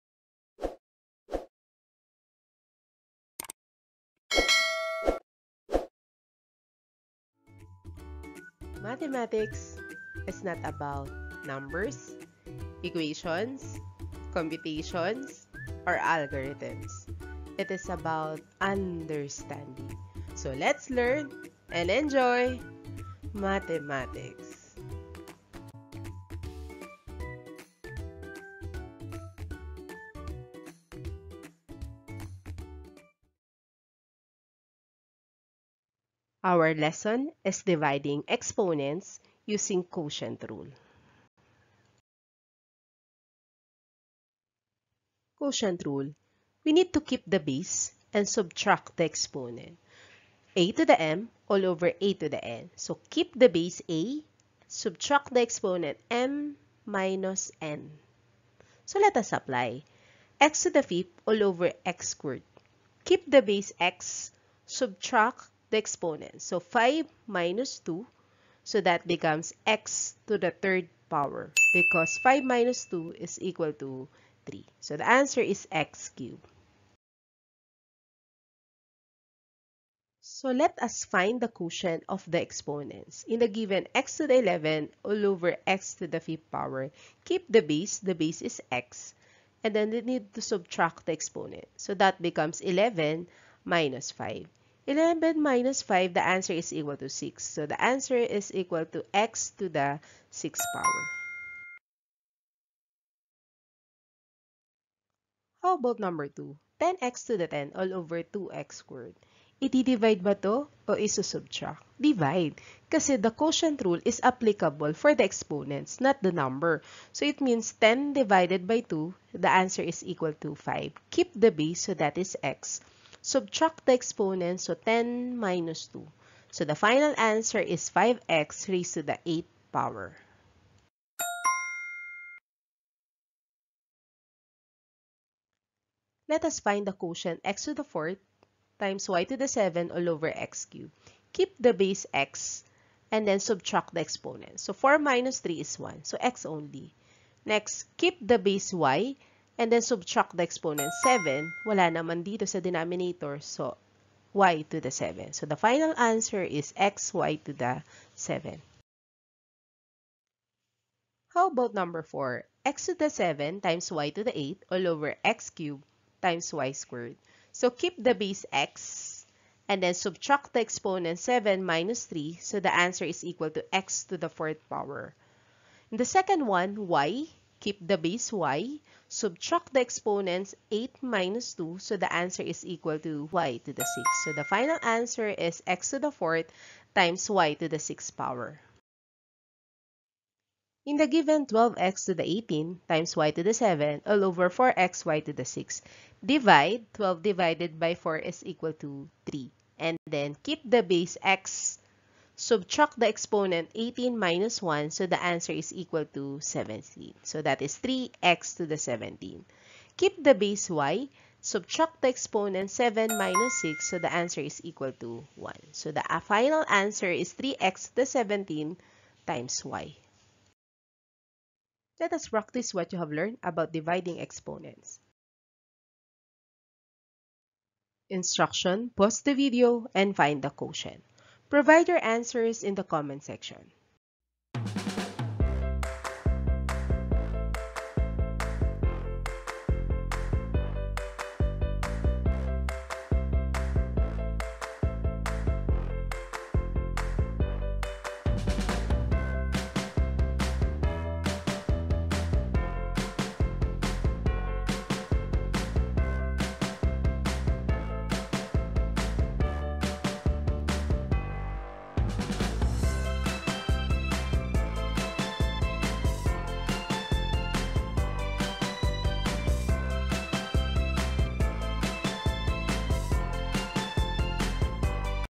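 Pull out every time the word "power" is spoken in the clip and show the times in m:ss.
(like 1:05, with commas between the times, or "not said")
1:11, 1:26, 1:40, 2:09, 2:54, 3:08.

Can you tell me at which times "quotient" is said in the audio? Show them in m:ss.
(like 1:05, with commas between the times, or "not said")
0:39, 0:45, 1:21, 1:53, 2:16, 3:50.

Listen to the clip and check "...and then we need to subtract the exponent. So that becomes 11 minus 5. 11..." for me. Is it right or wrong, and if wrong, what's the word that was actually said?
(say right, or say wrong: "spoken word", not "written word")
right.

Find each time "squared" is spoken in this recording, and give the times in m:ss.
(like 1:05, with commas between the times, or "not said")
1:02, 1:48, 2:46.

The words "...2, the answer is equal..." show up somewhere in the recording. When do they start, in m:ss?
1:58.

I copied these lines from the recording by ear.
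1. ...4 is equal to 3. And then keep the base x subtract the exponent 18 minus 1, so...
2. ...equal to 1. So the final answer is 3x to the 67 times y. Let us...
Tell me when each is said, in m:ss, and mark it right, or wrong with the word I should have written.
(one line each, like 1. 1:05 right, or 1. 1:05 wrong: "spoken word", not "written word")
1. 3:17 right
2. 3:34 wrong: "17", not "67".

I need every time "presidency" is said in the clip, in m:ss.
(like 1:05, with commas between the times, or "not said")
not said.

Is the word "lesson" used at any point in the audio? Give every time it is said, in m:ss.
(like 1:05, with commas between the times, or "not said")
0:36.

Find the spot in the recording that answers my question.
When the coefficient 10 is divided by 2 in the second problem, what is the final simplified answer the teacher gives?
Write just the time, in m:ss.
2:07.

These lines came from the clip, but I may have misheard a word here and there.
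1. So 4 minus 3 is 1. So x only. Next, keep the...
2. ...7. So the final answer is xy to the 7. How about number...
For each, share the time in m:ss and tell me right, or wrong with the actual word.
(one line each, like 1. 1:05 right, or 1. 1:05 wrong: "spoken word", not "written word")
1. 2:24 right
2. 2:34 right.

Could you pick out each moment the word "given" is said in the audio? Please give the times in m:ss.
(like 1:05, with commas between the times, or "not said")
1:23, 3:11.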